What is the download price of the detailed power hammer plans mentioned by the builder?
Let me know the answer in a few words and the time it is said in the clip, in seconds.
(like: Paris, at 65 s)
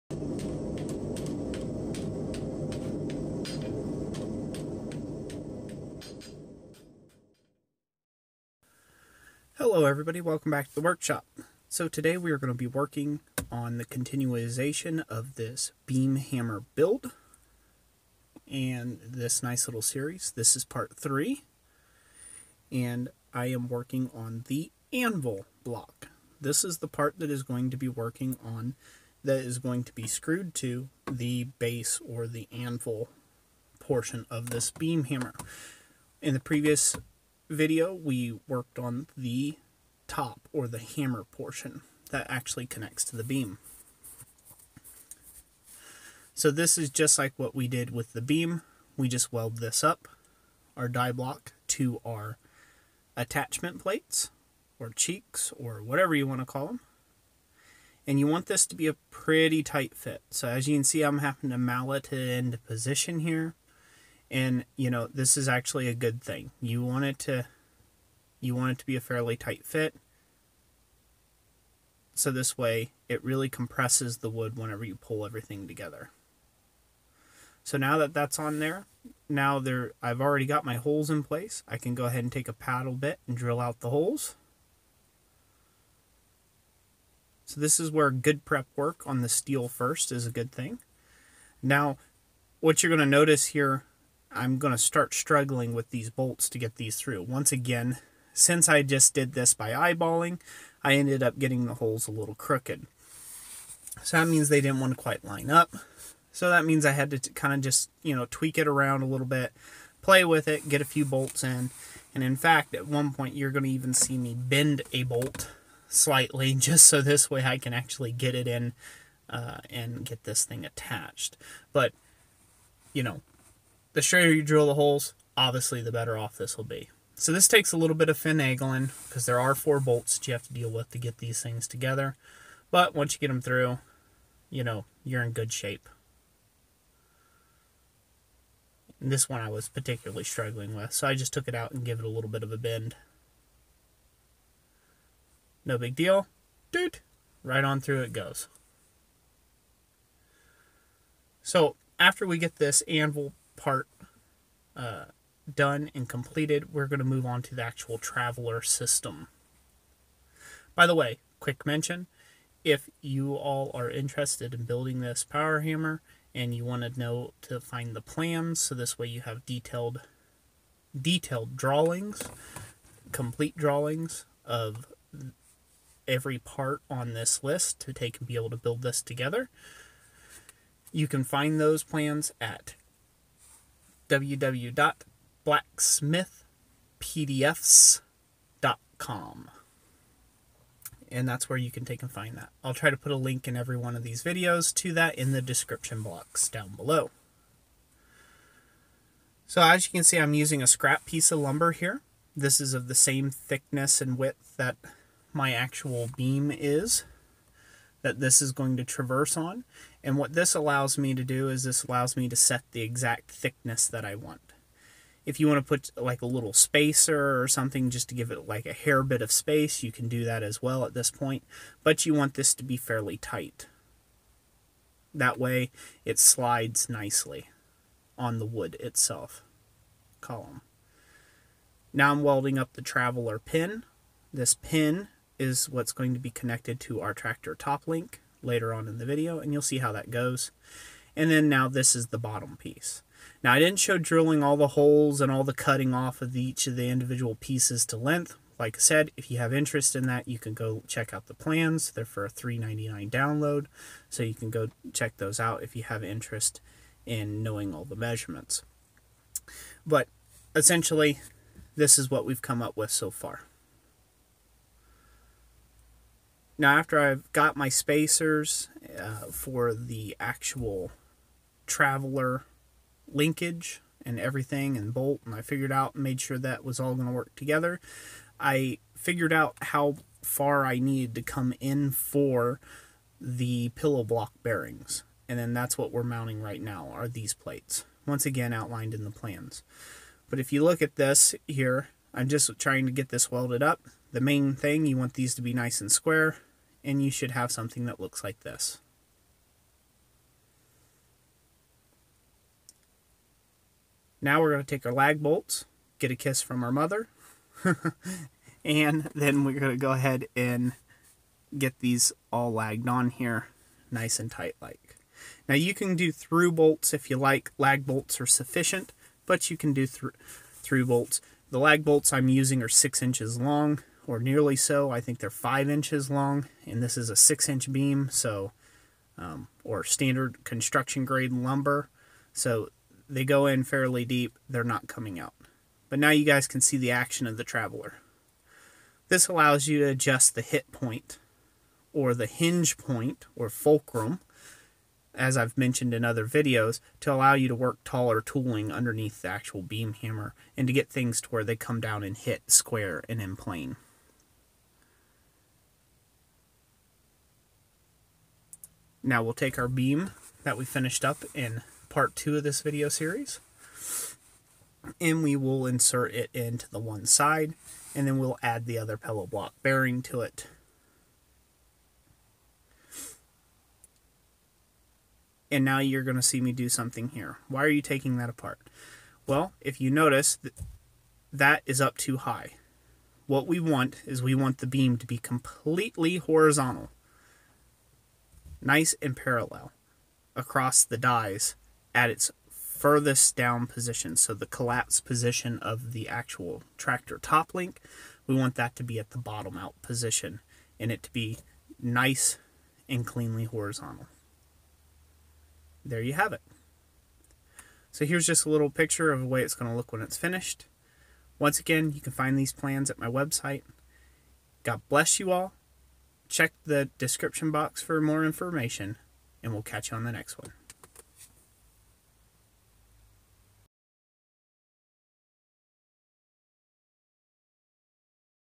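$3.99, at 252 s.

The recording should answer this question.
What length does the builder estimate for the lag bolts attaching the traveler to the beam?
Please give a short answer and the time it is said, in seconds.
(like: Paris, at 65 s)
5 inches, at 325 s.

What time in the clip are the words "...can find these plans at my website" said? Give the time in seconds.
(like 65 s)
411 s.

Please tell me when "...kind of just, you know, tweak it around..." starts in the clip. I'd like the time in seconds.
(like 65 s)
107 s.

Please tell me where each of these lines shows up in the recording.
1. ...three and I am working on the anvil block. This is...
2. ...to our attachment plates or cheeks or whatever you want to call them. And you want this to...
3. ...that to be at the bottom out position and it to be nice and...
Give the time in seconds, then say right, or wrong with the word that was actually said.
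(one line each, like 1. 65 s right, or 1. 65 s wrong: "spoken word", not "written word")
1. 20 s right
2. 51 s right
3. 398 s right.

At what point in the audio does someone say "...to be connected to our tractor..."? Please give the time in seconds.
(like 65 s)
236 s.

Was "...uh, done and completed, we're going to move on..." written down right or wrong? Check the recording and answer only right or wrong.
right.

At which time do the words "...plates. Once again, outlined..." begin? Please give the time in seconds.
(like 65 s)
287 s.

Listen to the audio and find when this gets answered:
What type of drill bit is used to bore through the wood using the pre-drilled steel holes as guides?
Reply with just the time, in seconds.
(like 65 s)
82 s.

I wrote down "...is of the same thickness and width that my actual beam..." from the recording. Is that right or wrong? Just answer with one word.
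right.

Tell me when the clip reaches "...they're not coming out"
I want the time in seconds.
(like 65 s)
334 s.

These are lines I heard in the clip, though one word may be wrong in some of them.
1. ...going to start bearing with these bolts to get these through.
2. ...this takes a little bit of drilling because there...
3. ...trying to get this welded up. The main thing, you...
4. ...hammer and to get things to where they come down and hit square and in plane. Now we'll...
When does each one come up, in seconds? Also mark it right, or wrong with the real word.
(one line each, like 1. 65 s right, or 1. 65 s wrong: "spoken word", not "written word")
1. 94 s wrong: "struggling", not "bearing"
2. 127 s wrong: "finagling", not "drilling"
3. 292 s right
4. 349 s right.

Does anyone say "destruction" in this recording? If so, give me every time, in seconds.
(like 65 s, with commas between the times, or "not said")
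not said.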